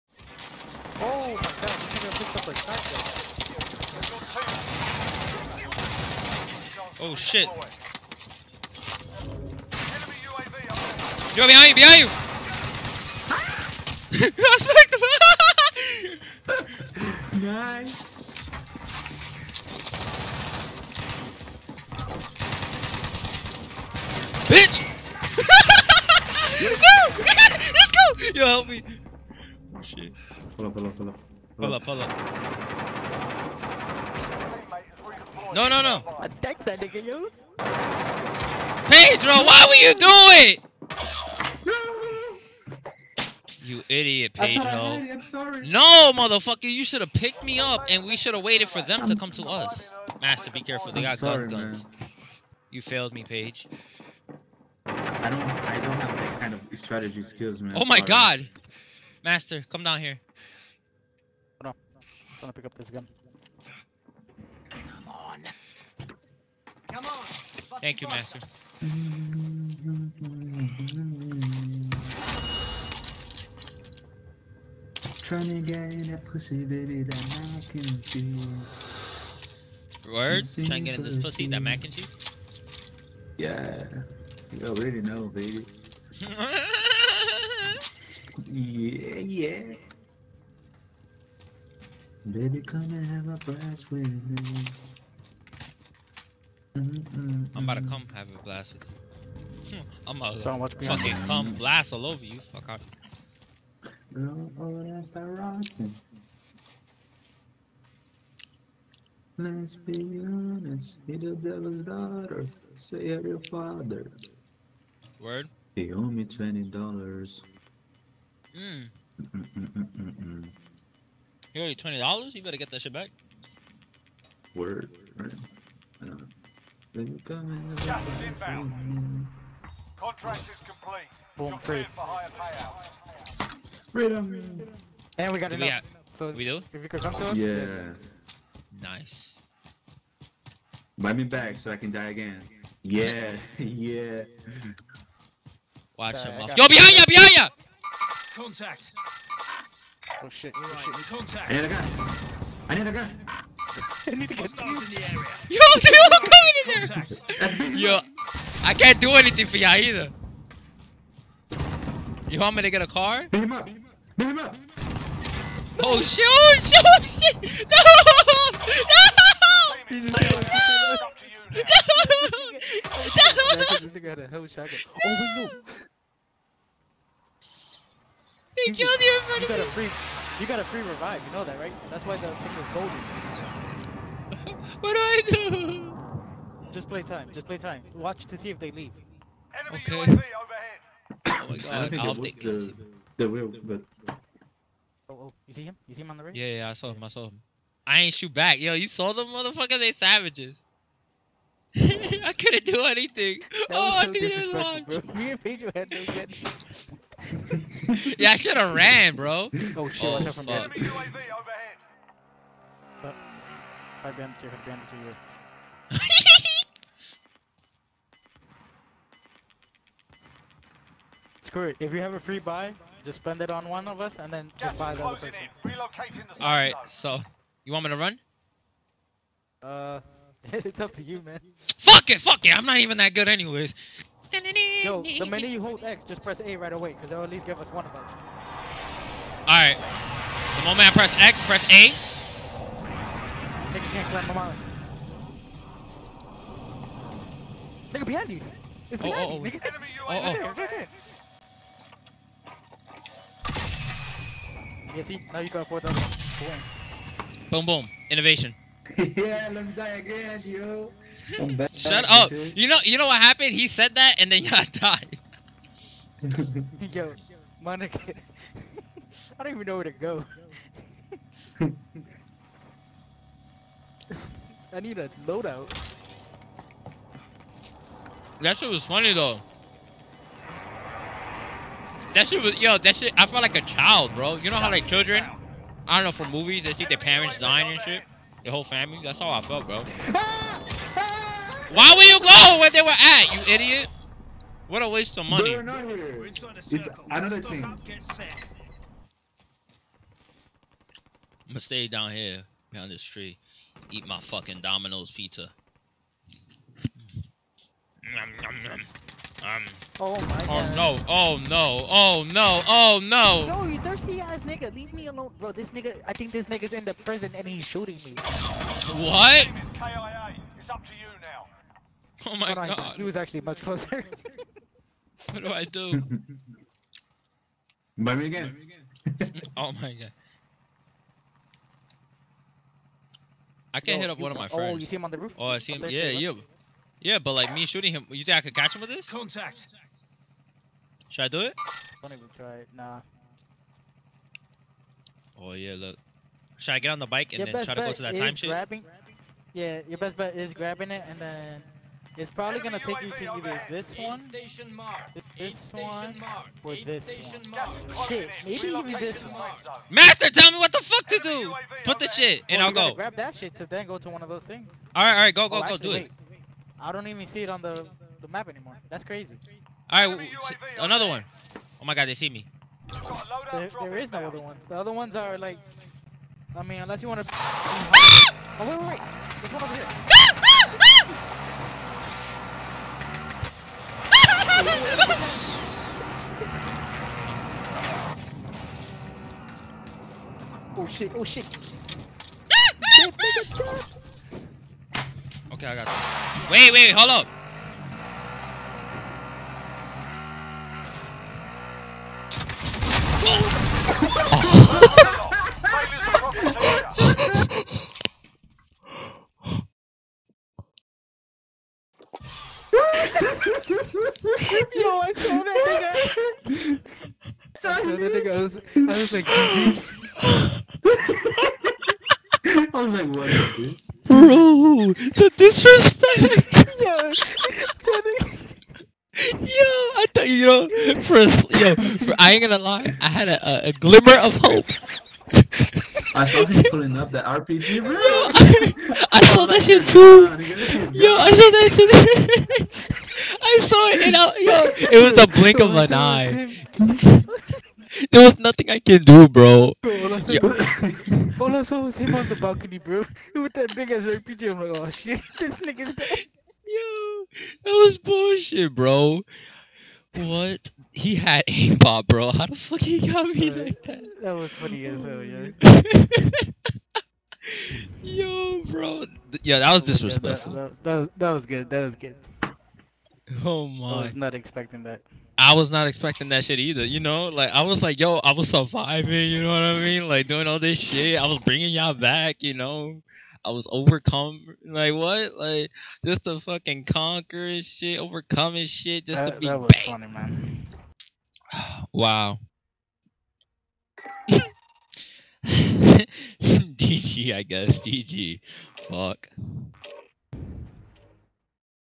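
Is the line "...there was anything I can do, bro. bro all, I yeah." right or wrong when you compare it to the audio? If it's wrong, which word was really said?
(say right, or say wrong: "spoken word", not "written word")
wrong: "nothing", not "anything".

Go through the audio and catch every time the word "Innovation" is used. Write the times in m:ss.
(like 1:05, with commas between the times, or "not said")
4:18.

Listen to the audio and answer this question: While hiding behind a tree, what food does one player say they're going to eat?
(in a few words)
Domino's pizza.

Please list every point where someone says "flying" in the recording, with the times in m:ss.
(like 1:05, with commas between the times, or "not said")
not said.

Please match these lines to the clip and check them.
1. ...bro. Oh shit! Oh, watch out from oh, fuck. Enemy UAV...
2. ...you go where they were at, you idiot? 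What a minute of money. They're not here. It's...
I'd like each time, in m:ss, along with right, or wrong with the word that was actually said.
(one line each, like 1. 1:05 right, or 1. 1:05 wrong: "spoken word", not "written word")
1. 3:29 right
2. 4:52 wrong: "waste", not "minute".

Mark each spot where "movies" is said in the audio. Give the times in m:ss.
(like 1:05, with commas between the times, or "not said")
4:46.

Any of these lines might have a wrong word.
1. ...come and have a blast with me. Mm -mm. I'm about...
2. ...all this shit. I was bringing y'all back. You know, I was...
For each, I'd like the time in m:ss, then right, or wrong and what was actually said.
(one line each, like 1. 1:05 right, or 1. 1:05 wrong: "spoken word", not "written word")
1. 1:32 right
2. 8:00 right.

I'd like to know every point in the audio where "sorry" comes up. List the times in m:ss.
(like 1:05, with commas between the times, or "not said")
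0:45, 0:51, 0:57, 6:57.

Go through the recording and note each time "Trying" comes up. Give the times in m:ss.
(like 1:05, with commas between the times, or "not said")
1:15, 1:20.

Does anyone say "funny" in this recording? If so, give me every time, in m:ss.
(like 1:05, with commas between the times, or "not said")
4:38, 7:44, 8:09.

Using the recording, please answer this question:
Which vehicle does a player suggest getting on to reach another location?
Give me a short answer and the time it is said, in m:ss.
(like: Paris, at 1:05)
bike, at 5:47.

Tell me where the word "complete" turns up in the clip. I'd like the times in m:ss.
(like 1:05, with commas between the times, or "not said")
2:10.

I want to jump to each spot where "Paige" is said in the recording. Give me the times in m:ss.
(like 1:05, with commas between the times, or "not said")
0:53.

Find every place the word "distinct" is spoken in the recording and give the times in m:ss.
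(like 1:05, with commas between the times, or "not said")
not said.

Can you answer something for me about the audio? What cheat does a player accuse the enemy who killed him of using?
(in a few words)
aimbot.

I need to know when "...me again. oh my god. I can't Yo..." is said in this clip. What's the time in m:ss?
5:28.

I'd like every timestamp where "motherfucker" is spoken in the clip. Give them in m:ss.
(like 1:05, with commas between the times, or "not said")
0:46, 3:19.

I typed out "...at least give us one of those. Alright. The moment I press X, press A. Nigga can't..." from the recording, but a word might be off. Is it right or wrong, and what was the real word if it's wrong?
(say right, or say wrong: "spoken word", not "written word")
right.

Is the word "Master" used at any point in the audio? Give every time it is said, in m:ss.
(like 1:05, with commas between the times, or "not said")
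0:50, 0:59, 1:08, 5:59.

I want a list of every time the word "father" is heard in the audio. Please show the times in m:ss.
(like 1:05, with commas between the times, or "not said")
1:53.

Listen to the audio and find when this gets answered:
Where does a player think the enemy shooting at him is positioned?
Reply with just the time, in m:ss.
5:16.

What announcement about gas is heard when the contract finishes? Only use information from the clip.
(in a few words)
Gas is inbound.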